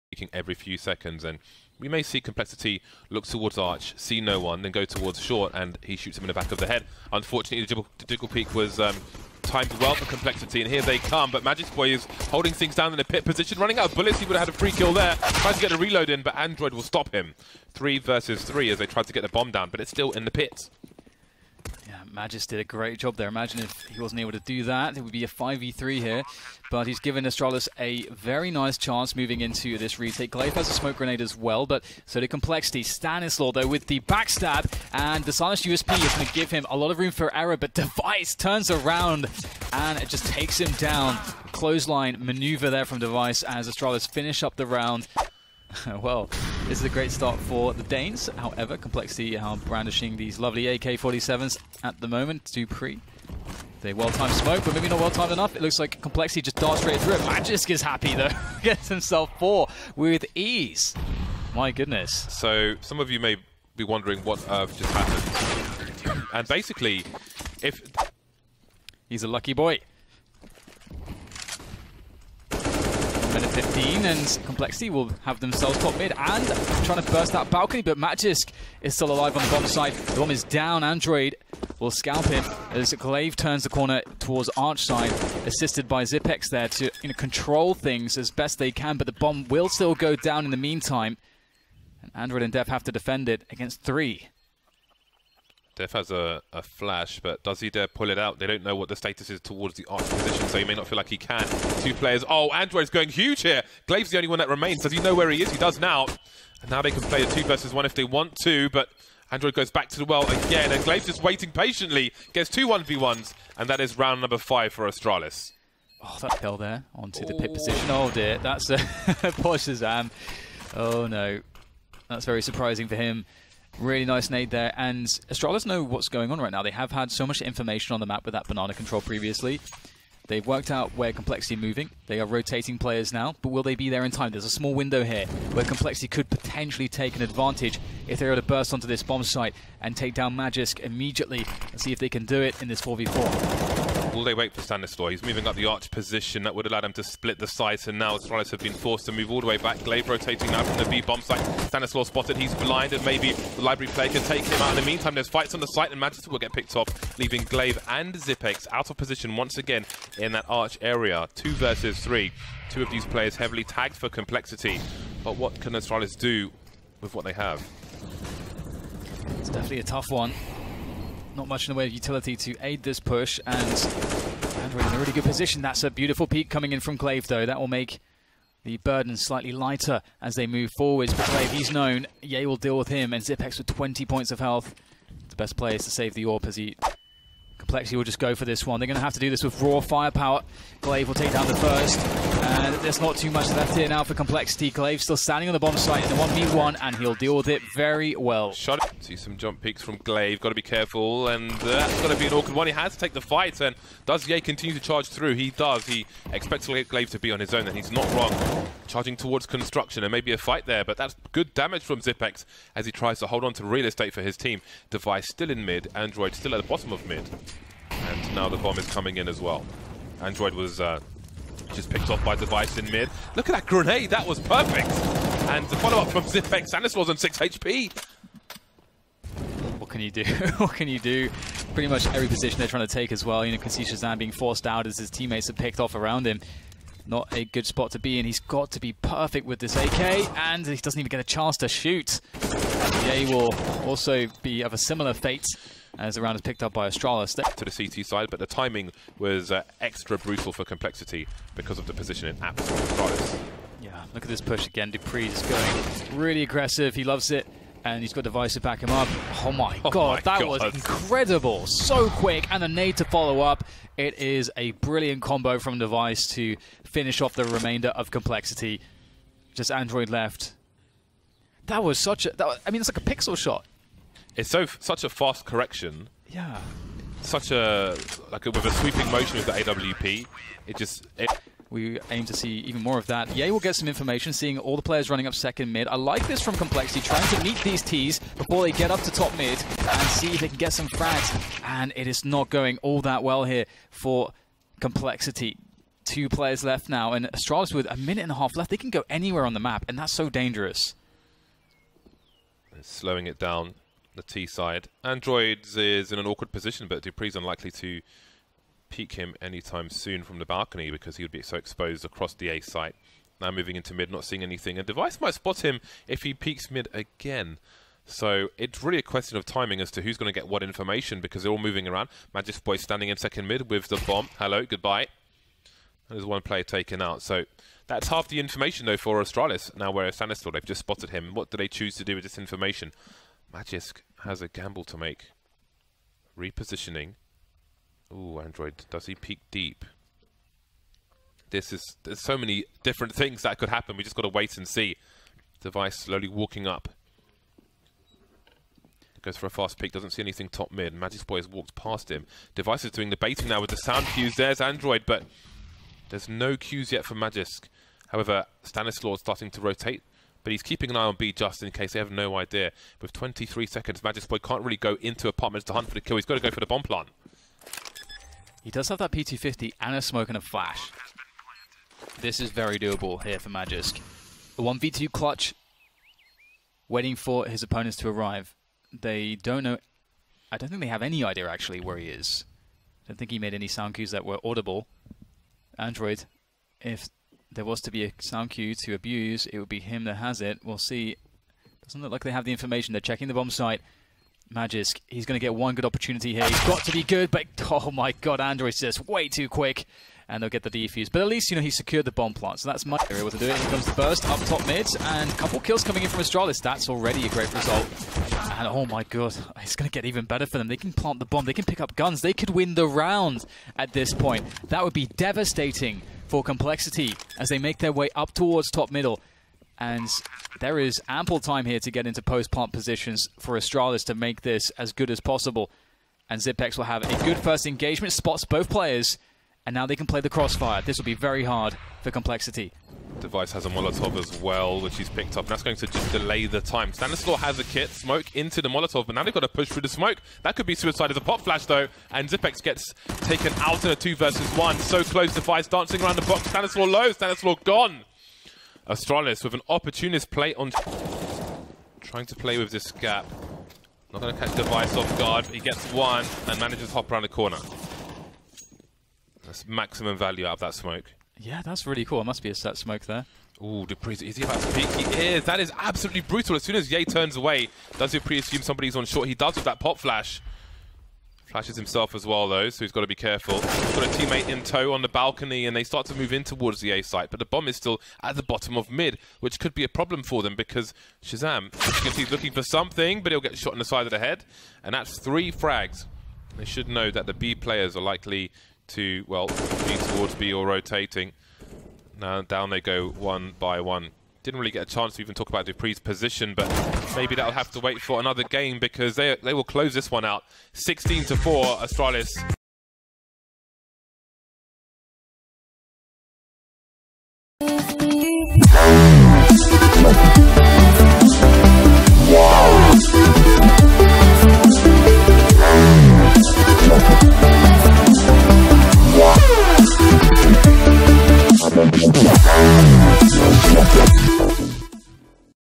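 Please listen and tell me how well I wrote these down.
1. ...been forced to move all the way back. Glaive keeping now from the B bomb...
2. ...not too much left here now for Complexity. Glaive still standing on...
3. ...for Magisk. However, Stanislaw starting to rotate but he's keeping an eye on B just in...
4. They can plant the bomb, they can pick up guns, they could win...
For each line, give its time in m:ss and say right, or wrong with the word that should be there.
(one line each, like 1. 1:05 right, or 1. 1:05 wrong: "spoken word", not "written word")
1. 2:28 wrong: "rotating", not "keeping"
2. 3:12 right
3. 5:57 right
4. 6:50 right.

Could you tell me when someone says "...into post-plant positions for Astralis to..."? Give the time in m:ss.
7:02.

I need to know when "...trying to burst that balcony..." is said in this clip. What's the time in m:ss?
1:16.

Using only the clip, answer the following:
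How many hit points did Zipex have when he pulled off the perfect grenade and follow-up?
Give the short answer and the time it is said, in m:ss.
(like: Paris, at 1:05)
6, at 3:47.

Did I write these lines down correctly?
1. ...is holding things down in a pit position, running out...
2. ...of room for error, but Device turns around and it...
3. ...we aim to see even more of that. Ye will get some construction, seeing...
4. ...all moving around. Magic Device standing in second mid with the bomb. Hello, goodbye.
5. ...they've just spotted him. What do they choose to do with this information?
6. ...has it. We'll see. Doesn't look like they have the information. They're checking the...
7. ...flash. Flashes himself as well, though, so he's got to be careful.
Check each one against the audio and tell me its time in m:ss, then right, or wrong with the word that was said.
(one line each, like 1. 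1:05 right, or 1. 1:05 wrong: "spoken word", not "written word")
1. 0:11 right
2. 0:36 right
3. 4:41 wrong: "information", not "construction"
4. 5:21 wrong: "Boy", not "Device"
5. 5:30 right
6. 6:30 right
7. 7:49 right.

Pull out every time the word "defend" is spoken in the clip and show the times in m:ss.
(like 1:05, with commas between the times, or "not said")
1:32.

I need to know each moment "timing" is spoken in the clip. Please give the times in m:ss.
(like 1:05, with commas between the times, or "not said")
4:08, 5:19.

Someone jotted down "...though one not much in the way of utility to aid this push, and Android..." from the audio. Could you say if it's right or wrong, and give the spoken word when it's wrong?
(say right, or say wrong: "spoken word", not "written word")
wrong: "tough", not "though".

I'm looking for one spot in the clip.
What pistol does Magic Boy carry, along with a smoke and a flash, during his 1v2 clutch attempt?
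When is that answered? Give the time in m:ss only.
6:09.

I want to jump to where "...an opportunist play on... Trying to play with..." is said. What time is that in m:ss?
7:29.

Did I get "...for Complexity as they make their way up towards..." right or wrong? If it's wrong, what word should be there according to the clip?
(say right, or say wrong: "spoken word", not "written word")
right.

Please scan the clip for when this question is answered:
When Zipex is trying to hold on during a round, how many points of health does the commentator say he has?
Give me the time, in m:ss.
3:03.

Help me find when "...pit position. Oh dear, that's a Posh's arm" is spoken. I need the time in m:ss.
1:57.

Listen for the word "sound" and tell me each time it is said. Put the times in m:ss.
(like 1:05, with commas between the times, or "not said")
5:53, 6:23, 6:28.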